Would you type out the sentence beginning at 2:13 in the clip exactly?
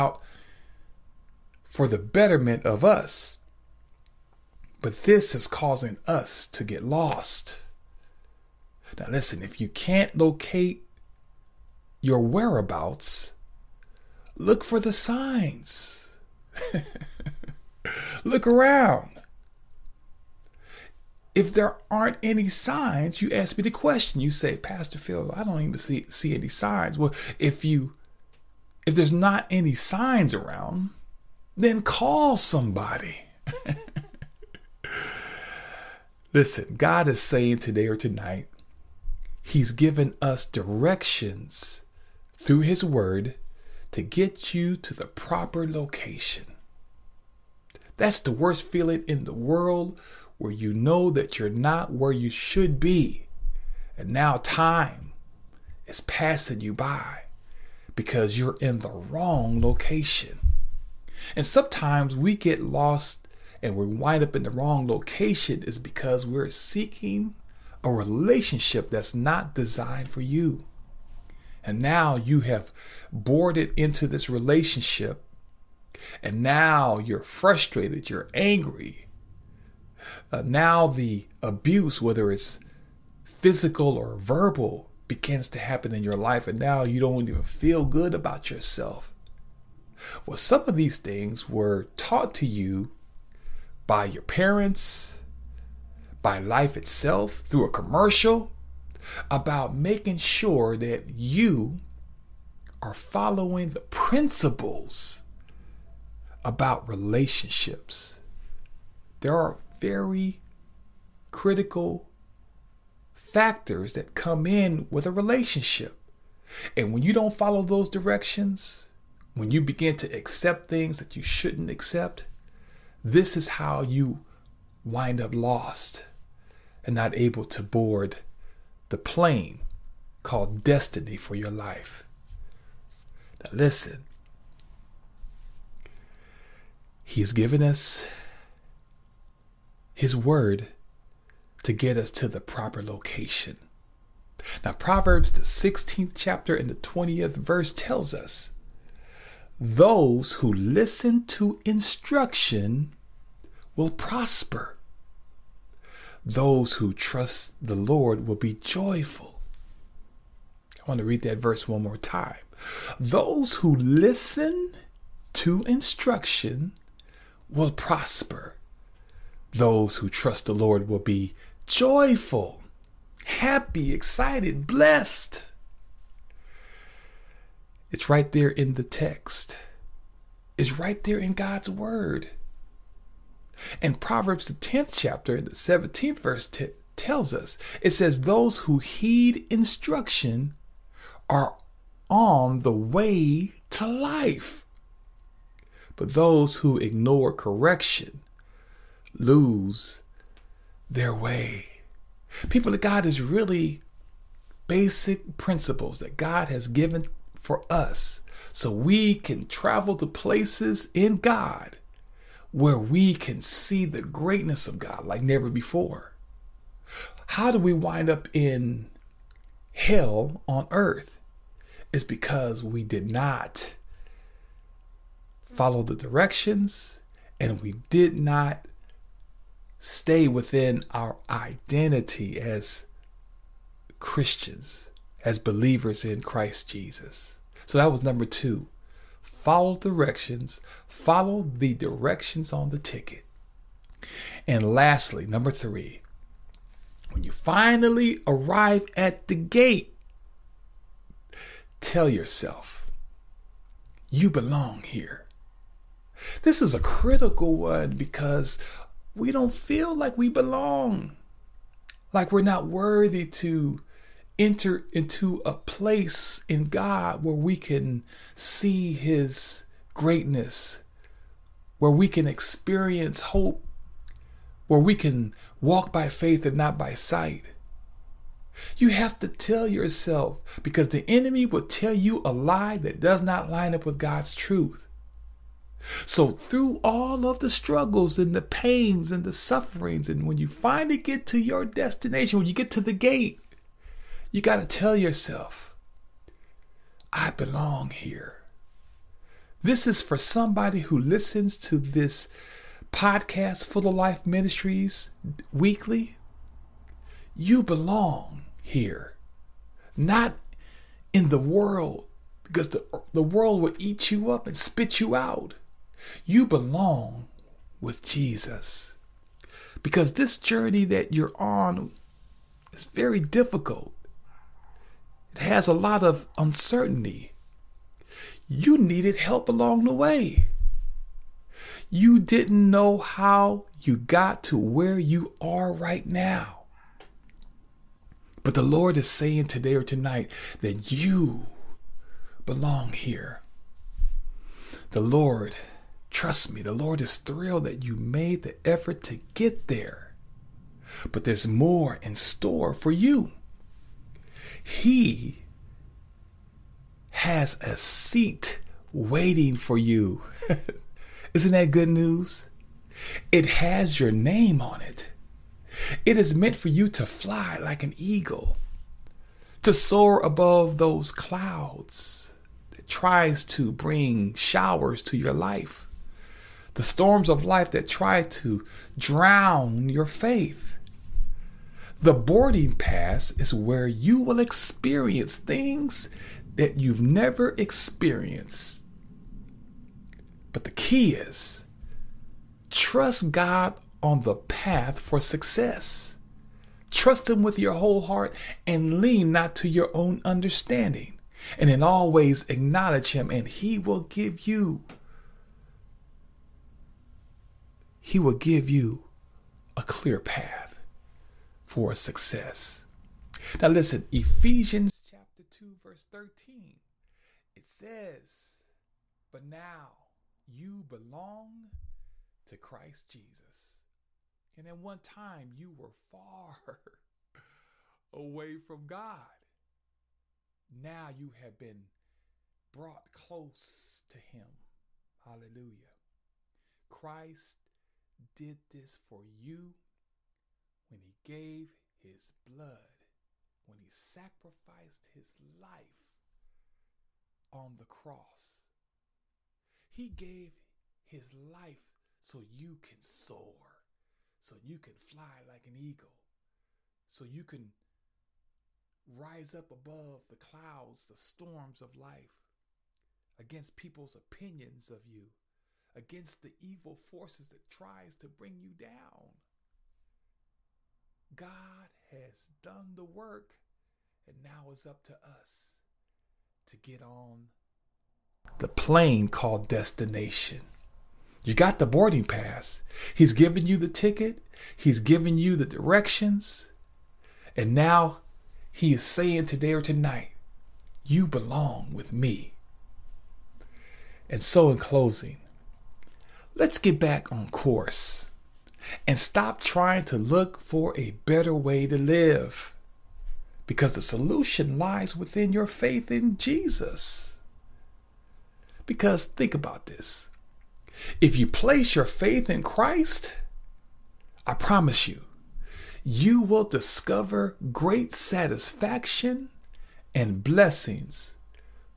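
Now, listen, He's given us His word to get us to the proper location.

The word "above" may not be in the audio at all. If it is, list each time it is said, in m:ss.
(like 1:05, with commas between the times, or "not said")
6:10, 7:39.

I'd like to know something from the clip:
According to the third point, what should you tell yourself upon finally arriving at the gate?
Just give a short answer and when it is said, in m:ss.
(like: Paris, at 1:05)
I belong here, at 4:57.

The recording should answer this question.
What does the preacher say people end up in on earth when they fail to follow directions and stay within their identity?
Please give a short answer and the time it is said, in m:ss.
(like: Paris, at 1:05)
Hell on earth, at 3:39.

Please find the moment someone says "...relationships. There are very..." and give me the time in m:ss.
1:46.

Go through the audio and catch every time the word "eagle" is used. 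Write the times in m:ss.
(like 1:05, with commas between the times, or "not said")
6:07, 7:35.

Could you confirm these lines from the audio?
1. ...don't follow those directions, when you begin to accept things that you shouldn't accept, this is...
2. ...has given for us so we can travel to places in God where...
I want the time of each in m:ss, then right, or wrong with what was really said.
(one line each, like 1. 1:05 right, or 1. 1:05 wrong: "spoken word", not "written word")
1. 1:57 right
2. 3:26 right.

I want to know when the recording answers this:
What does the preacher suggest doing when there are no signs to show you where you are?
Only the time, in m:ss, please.
0:31.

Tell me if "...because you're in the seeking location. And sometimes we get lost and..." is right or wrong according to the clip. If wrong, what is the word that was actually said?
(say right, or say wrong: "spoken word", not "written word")
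wrong: "wrong", not "seeking".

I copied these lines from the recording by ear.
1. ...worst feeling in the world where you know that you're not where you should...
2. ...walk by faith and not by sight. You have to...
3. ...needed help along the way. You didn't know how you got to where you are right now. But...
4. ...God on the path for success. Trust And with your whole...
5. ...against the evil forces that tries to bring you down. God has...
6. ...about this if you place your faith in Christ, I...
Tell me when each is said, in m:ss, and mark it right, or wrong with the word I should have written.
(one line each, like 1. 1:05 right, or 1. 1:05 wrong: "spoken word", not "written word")
1. 0:48 right
2. 4:35 right
3. 5:28 right
4. 6:33 wrong: "Him", not "And"
5. 7:45 right
6. 8:29 right.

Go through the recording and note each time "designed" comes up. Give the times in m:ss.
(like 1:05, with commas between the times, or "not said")
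1:09.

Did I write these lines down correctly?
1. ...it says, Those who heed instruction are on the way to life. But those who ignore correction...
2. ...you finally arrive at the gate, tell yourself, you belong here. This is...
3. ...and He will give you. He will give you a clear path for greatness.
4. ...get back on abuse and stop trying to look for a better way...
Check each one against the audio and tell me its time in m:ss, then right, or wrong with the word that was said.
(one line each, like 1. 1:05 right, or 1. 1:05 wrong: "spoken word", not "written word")
1. 3:07 right
2. 4:07 right
3. 6:43 wrong: "success", not "greatness"
4. 8:16 wrong: "course", not "abuse".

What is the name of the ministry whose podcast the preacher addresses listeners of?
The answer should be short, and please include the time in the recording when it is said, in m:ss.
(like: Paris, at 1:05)
Full of Life Ministries, at 5:03.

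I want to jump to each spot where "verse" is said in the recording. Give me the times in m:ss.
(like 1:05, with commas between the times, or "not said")
2:27, 2:41, 3:06, 6:55.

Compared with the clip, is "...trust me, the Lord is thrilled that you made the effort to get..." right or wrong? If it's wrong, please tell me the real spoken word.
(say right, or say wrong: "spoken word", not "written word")
right.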